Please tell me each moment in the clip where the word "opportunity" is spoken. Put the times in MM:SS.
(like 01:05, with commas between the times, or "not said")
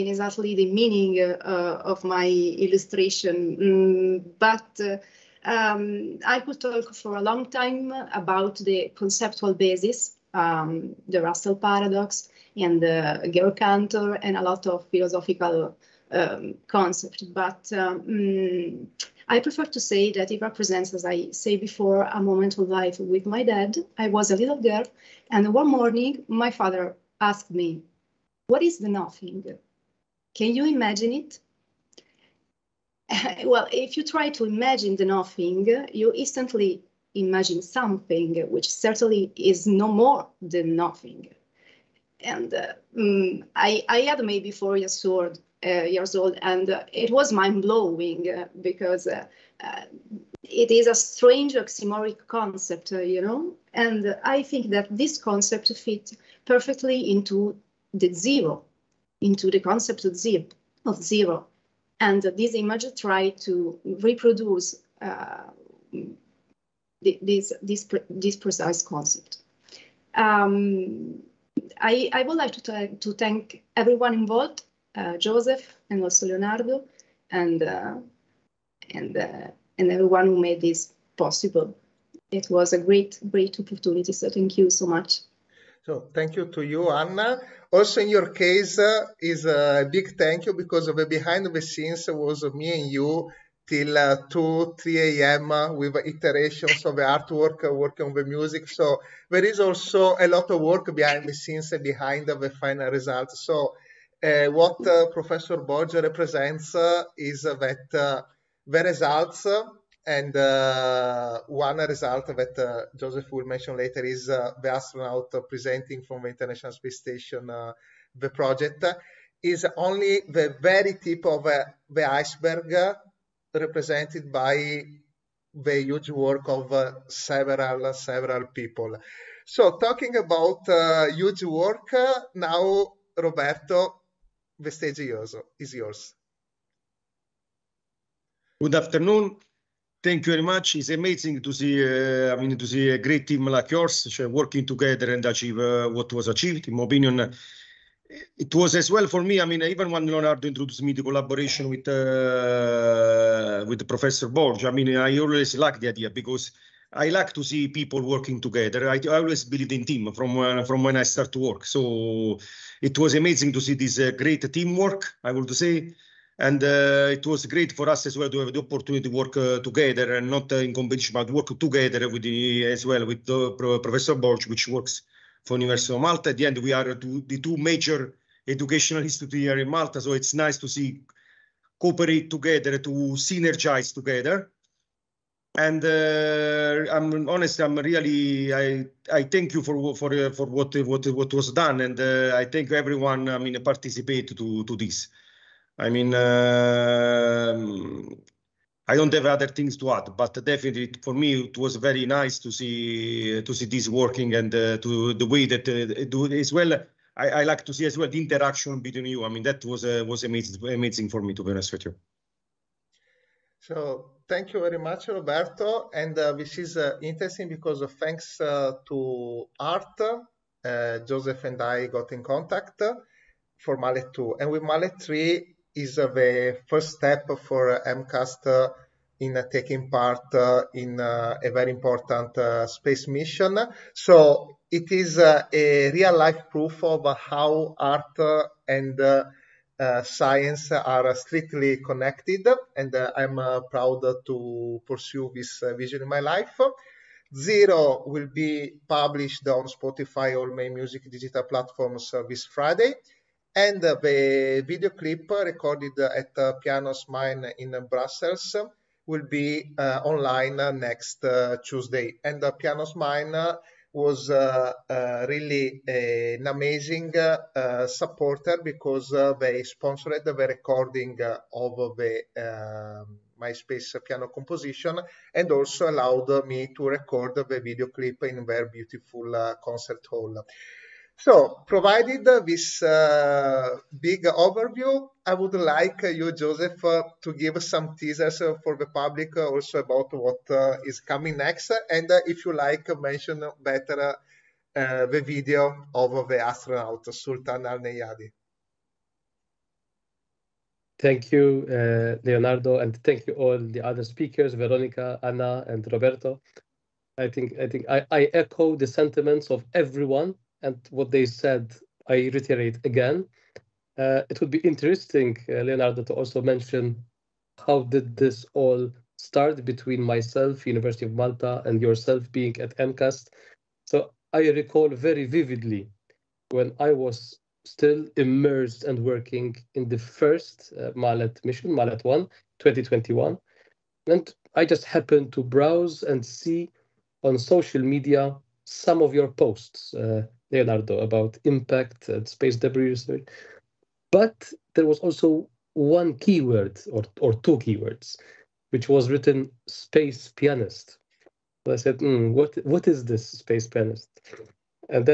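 01:23, 02:48.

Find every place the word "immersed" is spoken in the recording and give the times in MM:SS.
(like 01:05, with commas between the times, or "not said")
05:28.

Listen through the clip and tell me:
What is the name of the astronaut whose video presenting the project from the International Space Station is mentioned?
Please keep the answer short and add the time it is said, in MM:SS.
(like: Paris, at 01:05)
Sultan Al Neyadi, at 04:57.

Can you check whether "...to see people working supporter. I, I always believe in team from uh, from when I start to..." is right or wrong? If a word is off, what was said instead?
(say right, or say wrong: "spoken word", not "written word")
wrong: "together", not "supporter".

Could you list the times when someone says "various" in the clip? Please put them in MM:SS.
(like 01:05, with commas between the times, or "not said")
not said.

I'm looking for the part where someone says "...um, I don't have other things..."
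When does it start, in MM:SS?
03:16.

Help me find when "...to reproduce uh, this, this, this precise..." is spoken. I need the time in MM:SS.
01:03.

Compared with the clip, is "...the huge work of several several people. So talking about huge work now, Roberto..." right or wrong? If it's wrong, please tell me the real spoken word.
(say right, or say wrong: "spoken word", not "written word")
right.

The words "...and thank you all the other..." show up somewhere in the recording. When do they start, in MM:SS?
05:02.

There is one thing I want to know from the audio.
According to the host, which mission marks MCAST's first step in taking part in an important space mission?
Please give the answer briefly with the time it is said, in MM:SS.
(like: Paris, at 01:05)
Maleth 3, at 03:44.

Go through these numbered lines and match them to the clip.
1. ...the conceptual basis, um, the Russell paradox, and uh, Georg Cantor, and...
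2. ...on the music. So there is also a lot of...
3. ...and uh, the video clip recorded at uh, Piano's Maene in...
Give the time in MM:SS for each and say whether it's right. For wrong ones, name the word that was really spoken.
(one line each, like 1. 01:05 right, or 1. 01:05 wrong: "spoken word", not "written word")
1. 00:08 right
2. 01:38 right
3. 04:13 right.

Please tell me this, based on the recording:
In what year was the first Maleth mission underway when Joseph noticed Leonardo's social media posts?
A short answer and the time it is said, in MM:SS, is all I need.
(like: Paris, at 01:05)
2021, at 05:32.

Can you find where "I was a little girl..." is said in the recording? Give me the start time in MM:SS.
00:23.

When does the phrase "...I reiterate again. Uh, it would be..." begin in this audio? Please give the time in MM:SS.
05:12.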